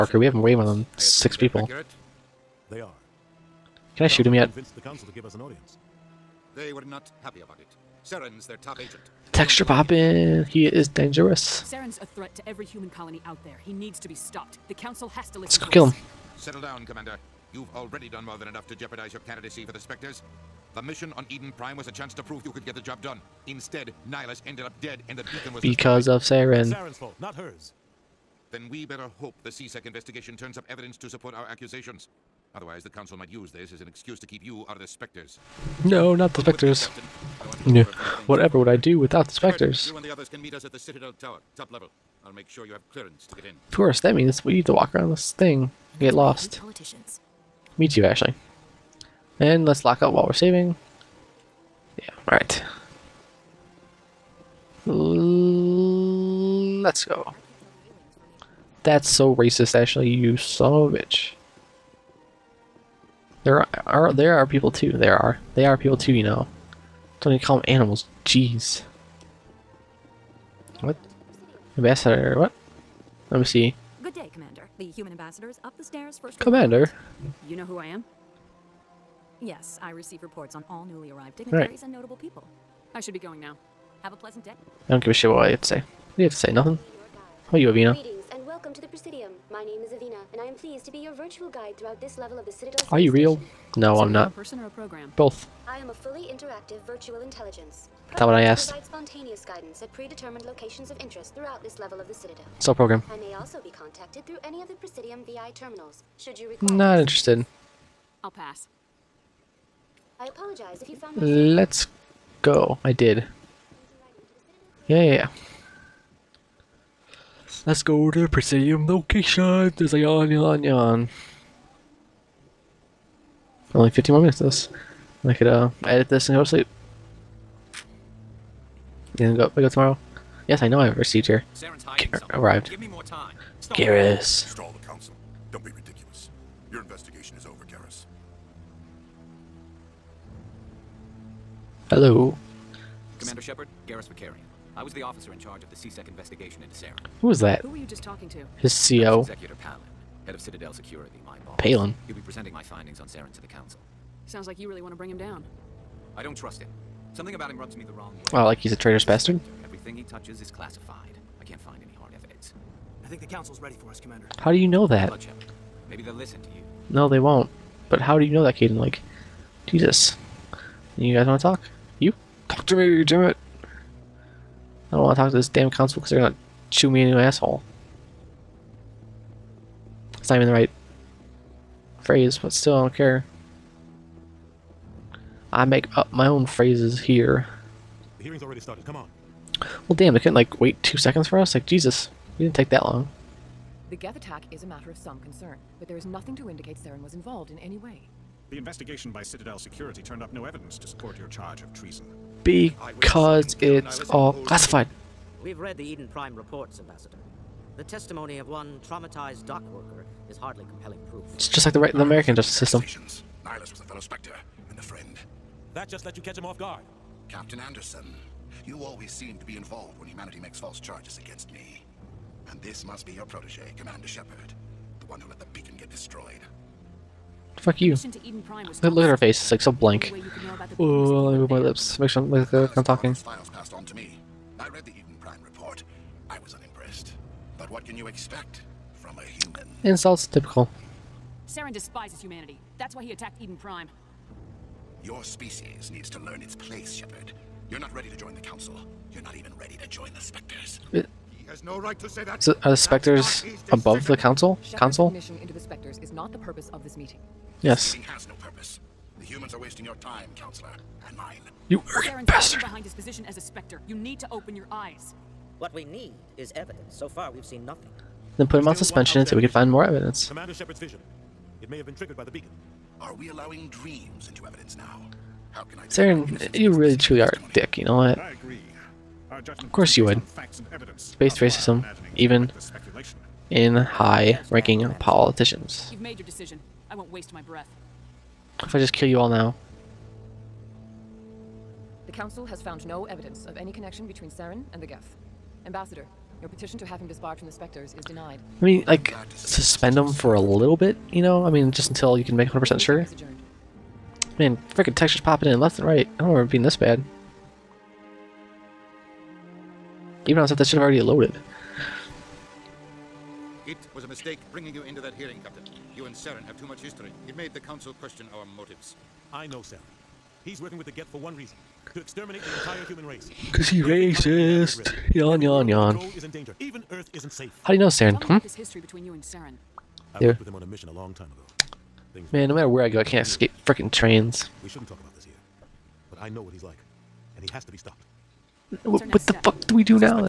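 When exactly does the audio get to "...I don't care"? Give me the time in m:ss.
3:02.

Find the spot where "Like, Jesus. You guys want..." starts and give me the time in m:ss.
2:48.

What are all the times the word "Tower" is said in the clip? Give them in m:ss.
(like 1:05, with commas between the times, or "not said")
0:41.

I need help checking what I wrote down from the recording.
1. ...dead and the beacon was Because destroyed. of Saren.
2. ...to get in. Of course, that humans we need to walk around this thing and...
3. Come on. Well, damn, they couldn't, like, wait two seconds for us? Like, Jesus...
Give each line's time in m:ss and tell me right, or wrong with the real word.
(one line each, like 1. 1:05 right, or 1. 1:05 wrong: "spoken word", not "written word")
1. 0:24 right
2. 0:43 wrong: "means", not "humans"
3. 3:08 right.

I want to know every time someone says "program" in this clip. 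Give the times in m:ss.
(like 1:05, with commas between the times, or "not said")
1:34, 1:42.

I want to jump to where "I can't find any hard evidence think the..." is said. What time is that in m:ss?
2:41.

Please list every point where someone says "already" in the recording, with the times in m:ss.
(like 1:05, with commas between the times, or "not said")
0:17, 3:08, 5:10.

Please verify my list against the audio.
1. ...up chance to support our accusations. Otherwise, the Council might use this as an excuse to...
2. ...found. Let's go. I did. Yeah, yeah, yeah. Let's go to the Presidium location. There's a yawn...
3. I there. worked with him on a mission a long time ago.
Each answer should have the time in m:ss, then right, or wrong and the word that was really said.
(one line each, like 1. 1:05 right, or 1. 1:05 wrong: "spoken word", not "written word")
1. 0:30 wrong: "evidence", not "chance"
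2. 1:50 right
3. 5:30 right.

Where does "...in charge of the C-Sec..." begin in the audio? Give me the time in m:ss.
2:25.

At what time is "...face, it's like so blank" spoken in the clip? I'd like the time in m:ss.
3:49.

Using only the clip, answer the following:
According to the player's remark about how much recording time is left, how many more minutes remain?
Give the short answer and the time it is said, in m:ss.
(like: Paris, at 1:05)
15, at 2:03.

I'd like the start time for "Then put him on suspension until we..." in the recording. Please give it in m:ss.
4:28.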